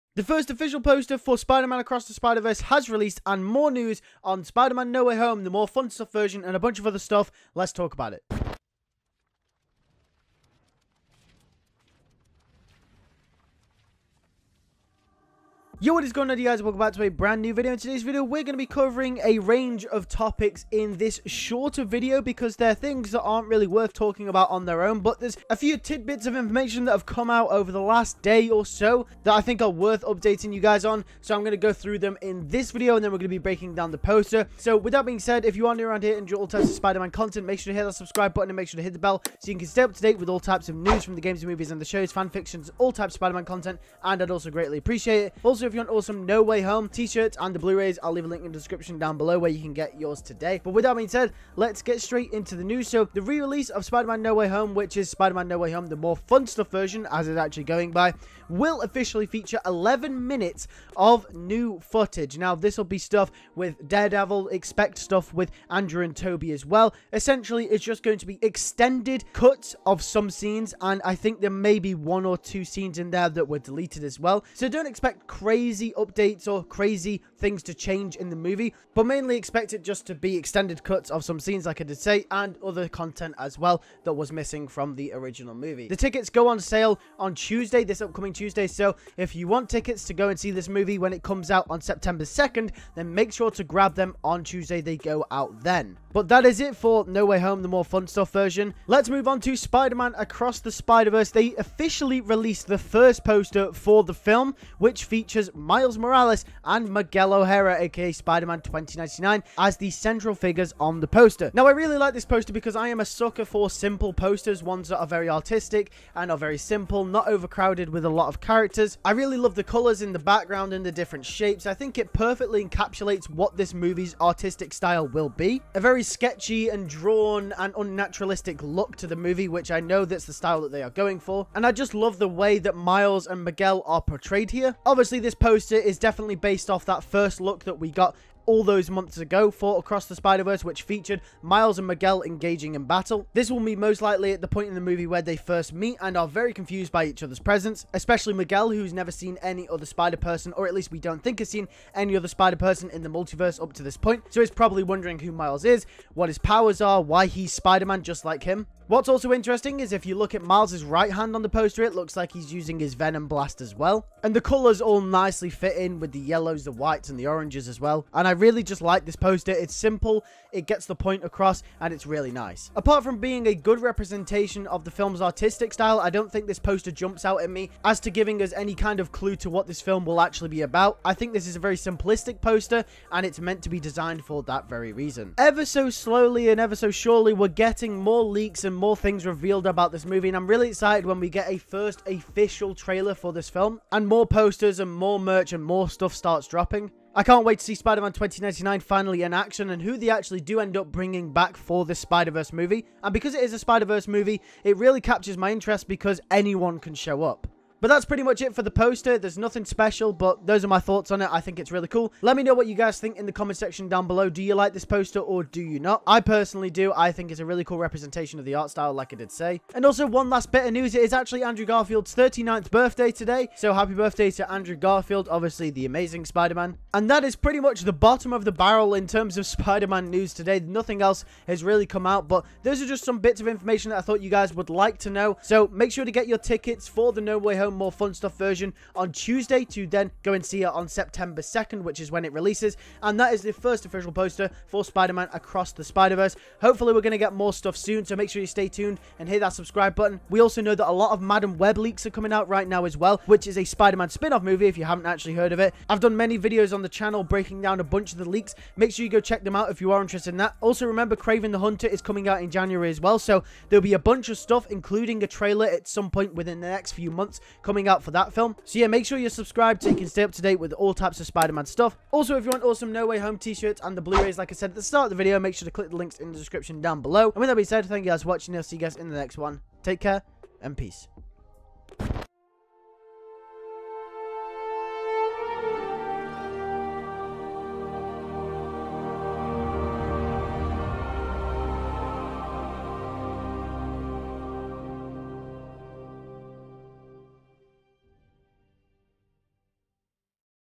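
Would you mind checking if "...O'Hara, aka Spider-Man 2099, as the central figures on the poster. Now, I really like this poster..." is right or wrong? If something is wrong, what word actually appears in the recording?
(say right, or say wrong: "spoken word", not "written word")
right.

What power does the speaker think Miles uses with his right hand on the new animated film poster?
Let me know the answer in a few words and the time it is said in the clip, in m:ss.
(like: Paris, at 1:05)
Venom Blast, at 2:42.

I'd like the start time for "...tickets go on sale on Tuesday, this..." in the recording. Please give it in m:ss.
1:25.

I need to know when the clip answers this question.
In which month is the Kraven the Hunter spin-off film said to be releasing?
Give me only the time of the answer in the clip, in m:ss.
4:22.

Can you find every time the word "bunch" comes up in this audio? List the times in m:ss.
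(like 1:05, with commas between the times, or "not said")
0:06, 4:17, 4:23.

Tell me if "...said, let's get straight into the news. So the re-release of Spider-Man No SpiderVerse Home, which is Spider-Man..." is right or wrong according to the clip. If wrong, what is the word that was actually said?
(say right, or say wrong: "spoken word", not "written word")
wrong: "Way", not "SpiderVerse".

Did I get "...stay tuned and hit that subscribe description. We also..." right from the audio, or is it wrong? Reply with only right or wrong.
wrong.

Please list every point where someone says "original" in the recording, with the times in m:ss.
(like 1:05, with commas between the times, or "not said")
1:25.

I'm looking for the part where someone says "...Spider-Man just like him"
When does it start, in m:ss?
2:37.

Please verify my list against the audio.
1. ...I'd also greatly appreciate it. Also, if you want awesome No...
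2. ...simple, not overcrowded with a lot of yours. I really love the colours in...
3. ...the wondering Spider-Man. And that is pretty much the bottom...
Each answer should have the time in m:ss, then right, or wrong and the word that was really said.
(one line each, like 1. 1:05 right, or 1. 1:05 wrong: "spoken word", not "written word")
1. 0:44 right
2. 1:56 wrong: "characters", not "yours"
3. 3:45 wrong: "amazing", not "wondering".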